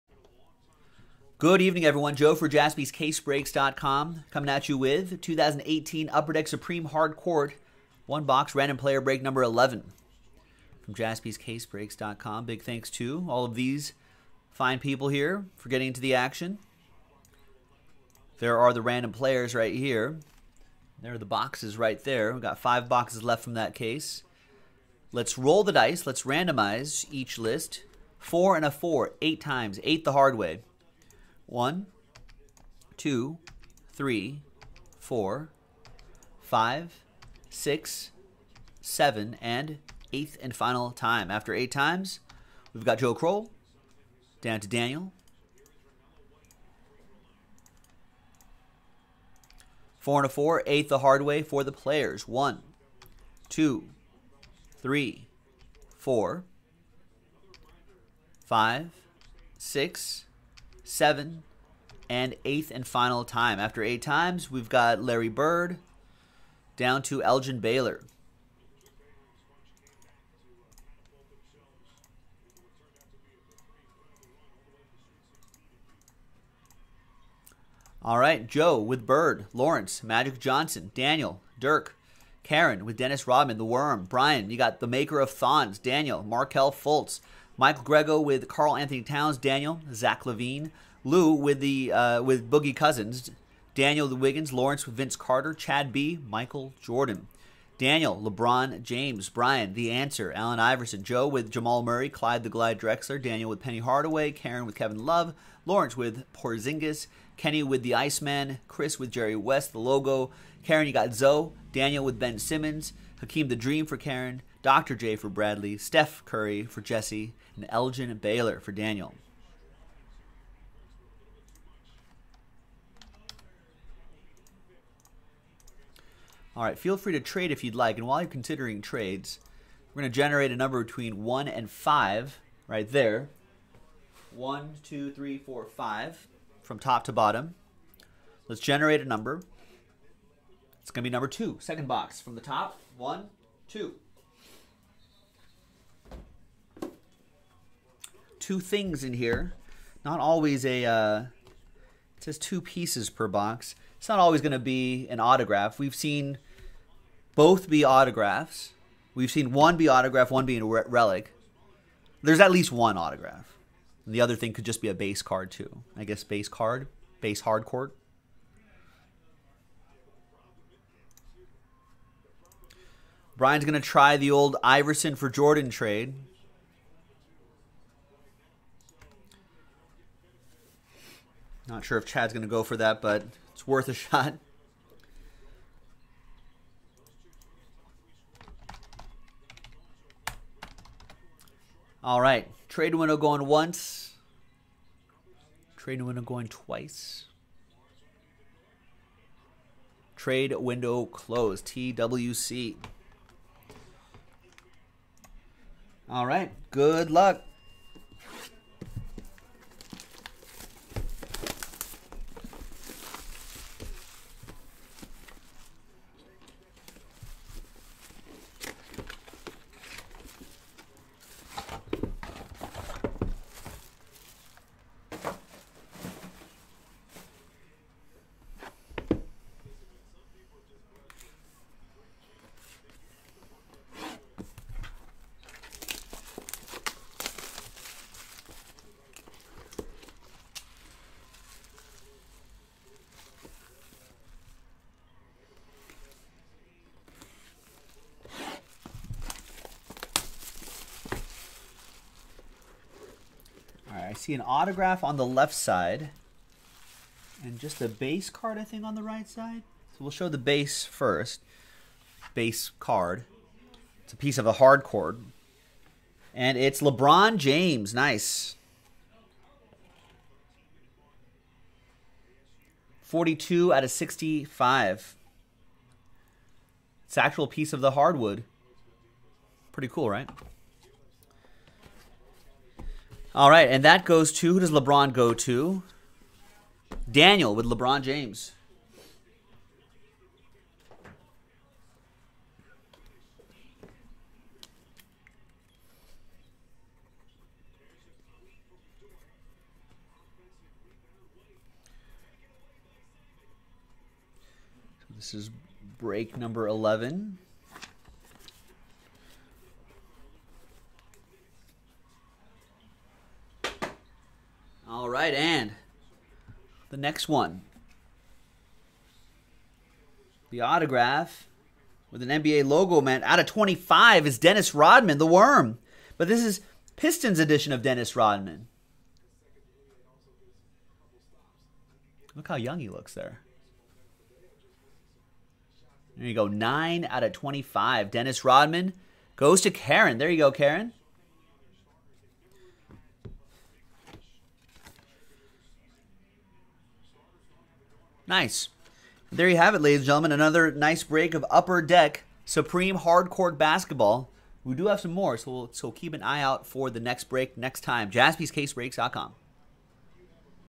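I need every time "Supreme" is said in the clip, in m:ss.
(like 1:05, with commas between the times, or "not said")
0:06, 5:52.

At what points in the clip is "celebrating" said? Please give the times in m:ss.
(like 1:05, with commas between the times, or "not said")
not said.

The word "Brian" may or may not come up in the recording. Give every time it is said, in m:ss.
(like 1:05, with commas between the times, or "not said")
1:24, 1:39, 2:53.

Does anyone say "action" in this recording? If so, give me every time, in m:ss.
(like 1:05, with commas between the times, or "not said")
0:16.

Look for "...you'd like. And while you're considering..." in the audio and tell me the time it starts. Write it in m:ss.
2:07.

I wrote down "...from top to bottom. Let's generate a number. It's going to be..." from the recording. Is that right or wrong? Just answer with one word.
right.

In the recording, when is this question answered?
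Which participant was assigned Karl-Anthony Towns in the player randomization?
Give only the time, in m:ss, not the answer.
1:27.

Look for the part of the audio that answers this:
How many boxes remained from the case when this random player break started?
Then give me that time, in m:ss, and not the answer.
0:22.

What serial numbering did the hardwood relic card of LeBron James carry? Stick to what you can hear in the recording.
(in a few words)
42 out of 65.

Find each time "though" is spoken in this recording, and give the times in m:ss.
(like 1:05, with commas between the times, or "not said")
not said.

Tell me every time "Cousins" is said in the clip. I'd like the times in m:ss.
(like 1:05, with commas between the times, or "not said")
1:32.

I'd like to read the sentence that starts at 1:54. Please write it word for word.
J for Bradley, Steph Curry for Jesse, and Elgin Baylor for Daniel.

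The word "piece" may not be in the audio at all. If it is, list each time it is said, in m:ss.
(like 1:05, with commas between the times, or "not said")
2:32, 4:24, 4:37.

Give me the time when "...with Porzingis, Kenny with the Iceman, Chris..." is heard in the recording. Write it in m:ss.
1:45.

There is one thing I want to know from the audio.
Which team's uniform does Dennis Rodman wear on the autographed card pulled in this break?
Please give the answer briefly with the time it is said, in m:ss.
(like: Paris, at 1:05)
Pistons, at 5:26.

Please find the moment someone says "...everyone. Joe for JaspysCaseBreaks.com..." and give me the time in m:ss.
0:01.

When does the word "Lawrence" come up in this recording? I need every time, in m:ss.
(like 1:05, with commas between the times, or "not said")
1:19, 1:34, 1:45.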